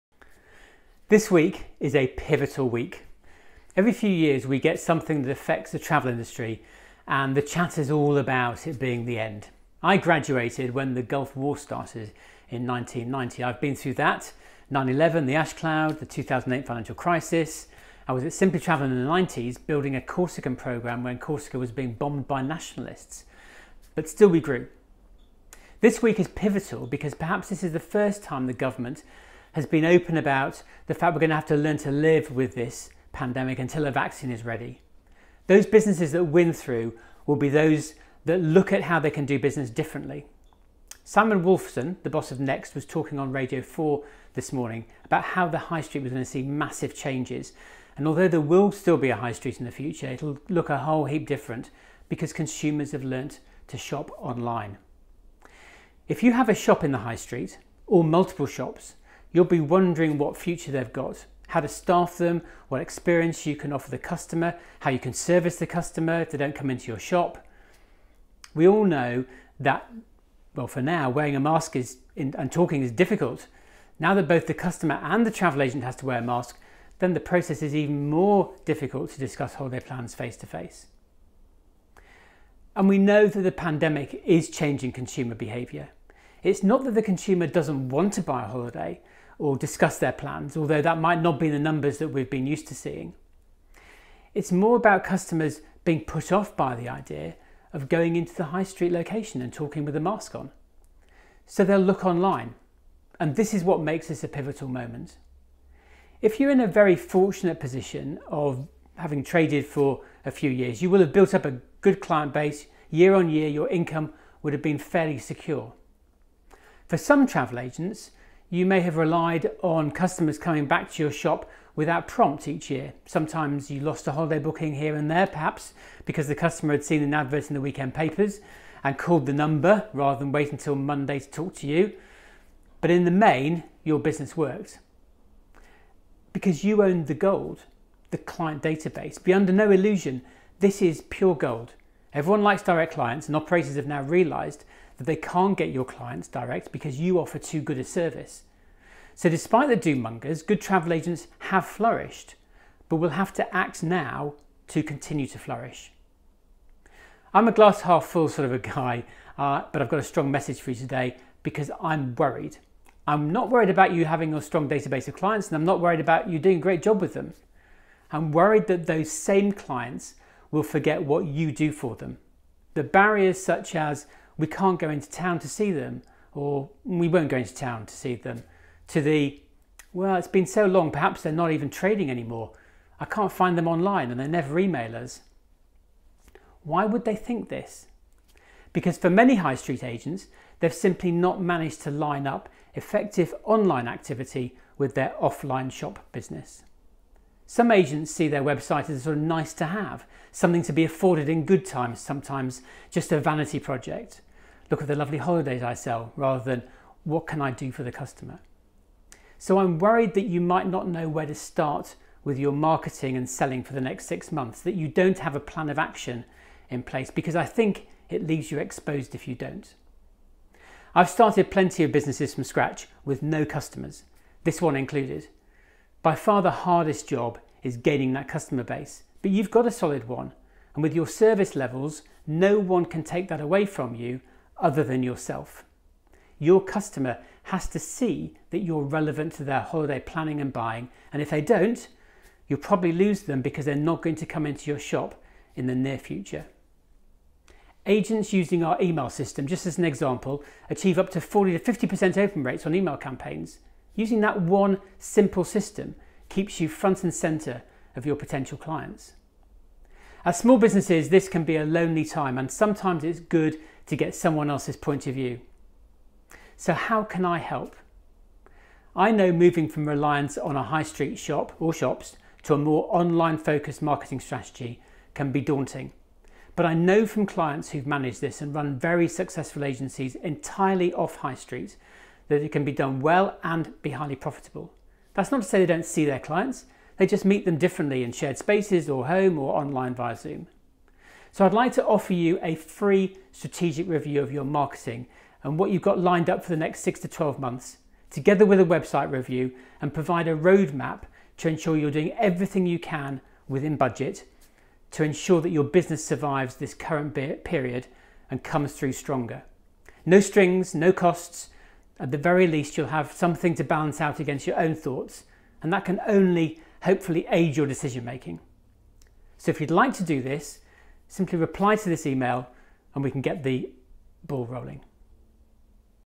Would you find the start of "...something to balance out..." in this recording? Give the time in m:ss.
5:13.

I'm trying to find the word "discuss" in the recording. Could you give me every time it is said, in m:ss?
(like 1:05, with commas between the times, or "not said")
1:19, 1:29.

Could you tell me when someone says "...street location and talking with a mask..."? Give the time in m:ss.
1:38.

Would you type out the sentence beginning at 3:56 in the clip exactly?
Your customer has to see that you're relevant to their holiday planning and buying.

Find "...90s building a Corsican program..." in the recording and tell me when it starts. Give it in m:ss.
0:19.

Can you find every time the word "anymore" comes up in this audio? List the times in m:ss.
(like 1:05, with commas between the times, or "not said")
3:02.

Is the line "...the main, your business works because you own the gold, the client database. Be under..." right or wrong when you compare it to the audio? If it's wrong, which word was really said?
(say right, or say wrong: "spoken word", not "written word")
right.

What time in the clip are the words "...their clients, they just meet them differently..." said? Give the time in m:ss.
4:46.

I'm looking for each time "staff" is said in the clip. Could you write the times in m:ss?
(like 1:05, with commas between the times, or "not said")
1:01.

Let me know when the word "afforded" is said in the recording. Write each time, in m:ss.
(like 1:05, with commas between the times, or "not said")
3:20.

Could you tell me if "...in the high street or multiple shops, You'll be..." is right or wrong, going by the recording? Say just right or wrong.
right.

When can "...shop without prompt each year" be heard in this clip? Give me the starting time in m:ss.
2:01.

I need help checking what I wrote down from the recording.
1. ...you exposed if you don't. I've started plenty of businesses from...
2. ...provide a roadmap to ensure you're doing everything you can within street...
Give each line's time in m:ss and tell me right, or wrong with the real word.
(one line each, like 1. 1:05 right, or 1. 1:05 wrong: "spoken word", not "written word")
1. 3:38 right
2. 4:59 wrong: "budget", not "street".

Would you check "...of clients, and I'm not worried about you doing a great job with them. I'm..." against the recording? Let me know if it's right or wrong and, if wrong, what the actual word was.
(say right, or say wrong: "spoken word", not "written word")
right.